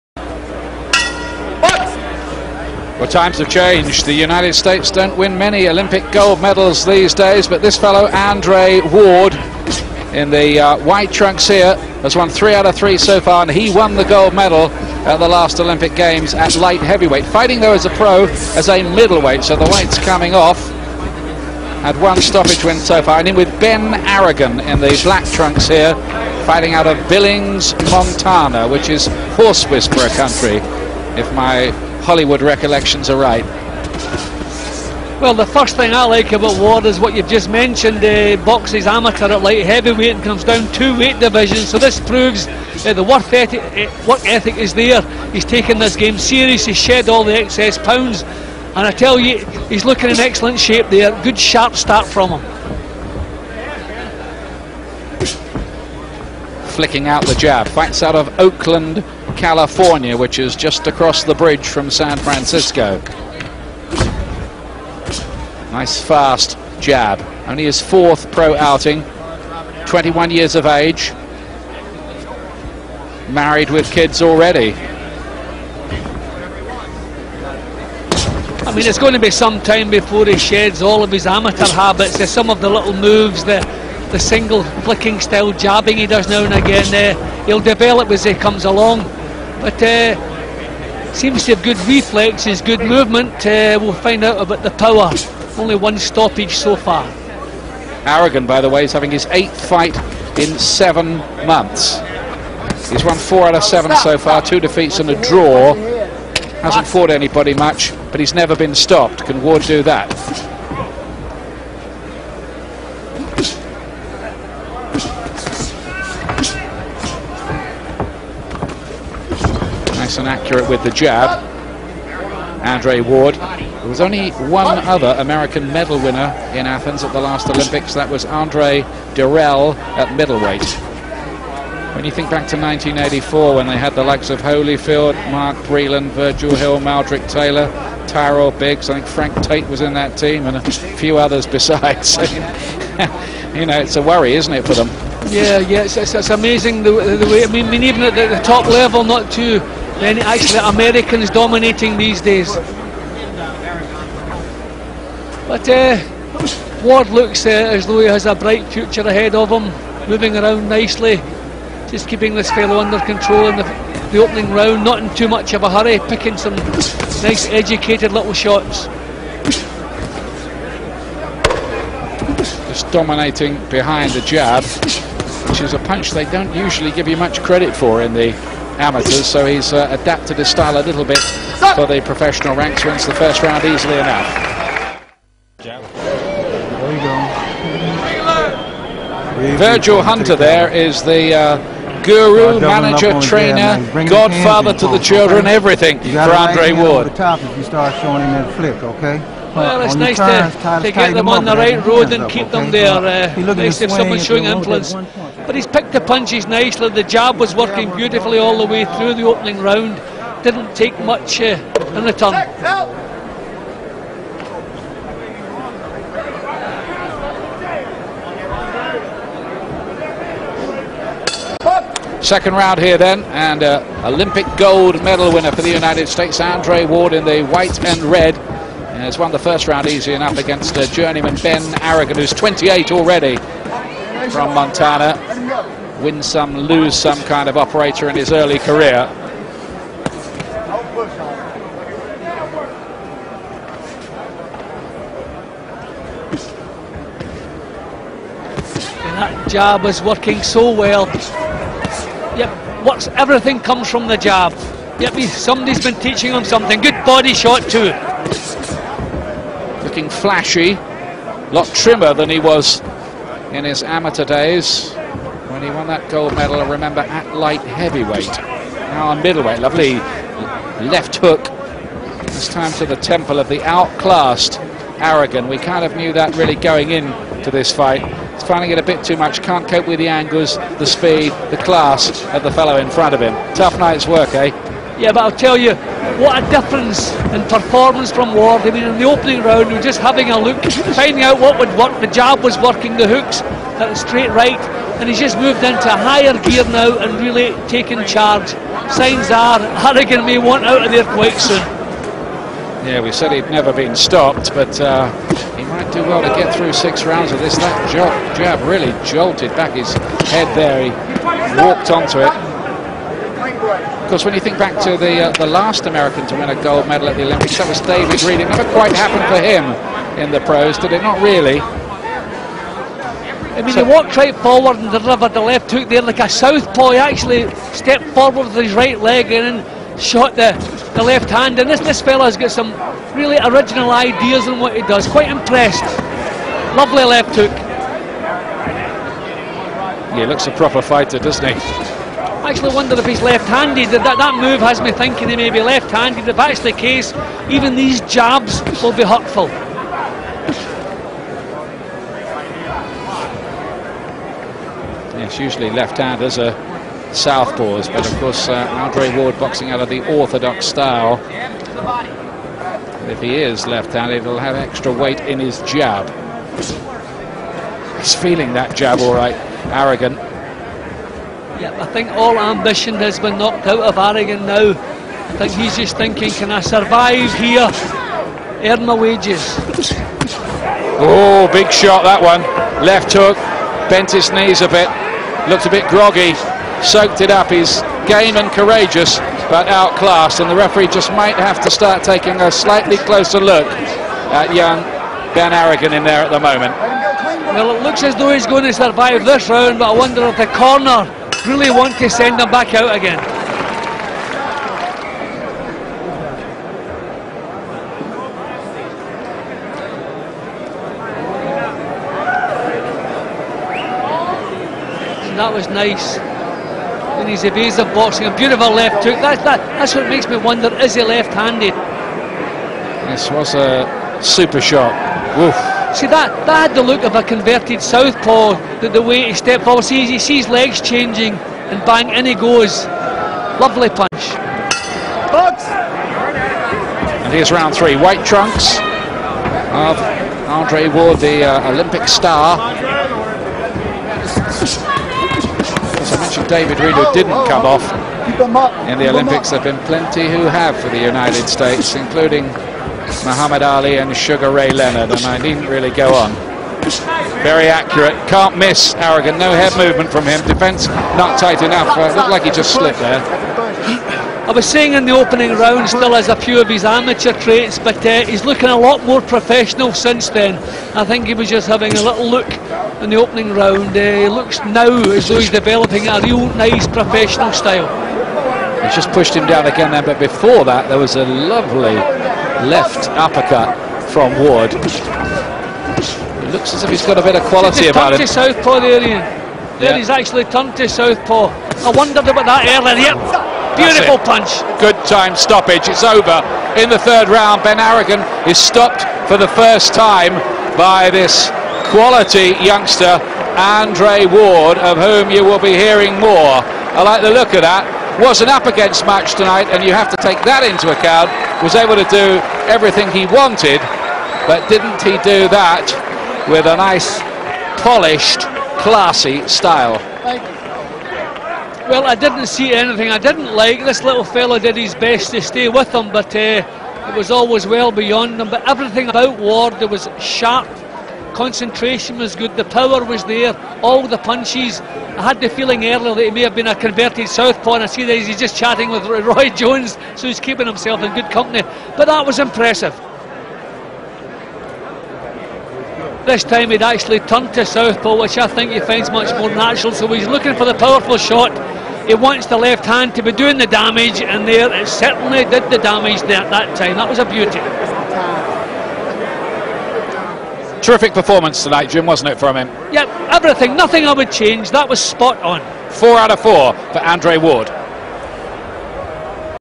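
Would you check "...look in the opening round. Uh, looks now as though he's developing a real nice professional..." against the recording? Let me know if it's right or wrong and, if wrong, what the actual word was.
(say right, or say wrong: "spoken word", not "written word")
right.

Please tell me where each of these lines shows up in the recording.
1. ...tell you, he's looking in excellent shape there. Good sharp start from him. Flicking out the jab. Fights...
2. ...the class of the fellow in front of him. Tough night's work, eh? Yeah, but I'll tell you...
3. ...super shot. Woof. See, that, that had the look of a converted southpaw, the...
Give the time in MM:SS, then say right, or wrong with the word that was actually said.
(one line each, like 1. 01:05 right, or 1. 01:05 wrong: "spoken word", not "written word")
1. 00:48 right
2. 04:41 right
3. 07:04 right.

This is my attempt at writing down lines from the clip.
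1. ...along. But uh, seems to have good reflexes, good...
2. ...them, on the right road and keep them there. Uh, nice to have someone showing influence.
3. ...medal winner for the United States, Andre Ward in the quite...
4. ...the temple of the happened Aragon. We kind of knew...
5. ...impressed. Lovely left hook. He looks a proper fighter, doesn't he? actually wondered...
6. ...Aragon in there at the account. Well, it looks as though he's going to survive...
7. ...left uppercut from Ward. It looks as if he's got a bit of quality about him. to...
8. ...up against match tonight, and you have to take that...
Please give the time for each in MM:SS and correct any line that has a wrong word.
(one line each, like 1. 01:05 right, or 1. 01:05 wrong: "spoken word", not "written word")
1. 01:28 right
2. 03:21 right
3. 03:45 wrong: "white", not "quite"
4. 04:32 wrong: "outclassed", not "happened"
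5. 05:35 right
6. 06:35 wrong: "moment", not "account"
7. 08:02 right
8. 08:28 right.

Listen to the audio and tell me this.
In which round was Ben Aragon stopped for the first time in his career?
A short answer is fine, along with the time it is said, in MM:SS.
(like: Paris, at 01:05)
third round, at 08:16.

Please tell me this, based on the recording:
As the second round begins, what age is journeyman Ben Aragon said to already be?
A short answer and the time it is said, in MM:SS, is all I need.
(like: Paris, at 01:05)
28, at 03:52.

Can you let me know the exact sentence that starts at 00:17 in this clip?
Fighting, though, as a pro, as a middleweight, so the weight's coming off.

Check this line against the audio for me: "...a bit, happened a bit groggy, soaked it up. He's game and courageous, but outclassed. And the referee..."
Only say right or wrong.
wrong.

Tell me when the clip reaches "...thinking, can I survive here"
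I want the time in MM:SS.
06:15.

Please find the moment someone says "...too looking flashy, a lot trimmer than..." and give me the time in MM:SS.
04:17.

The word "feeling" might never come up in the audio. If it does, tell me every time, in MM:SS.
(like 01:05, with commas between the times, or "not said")
06:08, 08:55.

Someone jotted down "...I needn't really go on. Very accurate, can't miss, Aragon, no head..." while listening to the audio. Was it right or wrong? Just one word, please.
right.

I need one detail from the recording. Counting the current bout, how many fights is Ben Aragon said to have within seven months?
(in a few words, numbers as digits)
8.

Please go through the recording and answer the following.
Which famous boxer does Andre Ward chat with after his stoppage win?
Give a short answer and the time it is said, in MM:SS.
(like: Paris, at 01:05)
Roy Jones, at 08:59.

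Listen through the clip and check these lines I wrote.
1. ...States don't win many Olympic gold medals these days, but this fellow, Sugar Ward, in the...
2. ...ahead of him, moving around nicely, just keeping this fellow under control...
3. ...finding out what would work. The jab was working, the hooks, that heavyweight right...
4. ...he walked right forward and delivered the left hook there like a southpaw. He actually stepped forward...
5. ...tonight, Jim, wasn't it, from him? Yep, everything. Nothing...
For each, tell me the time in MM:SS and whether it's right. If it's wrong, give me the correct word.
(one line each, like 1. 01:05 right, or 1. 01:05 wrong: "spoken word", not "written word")
1. 00:04 wrong: "Andre", not "Sugar"
2. 02:39 right
3. 04:50 wrong: "straight", not "heavyweight"
4. 05:23 right
5. 09:21 right.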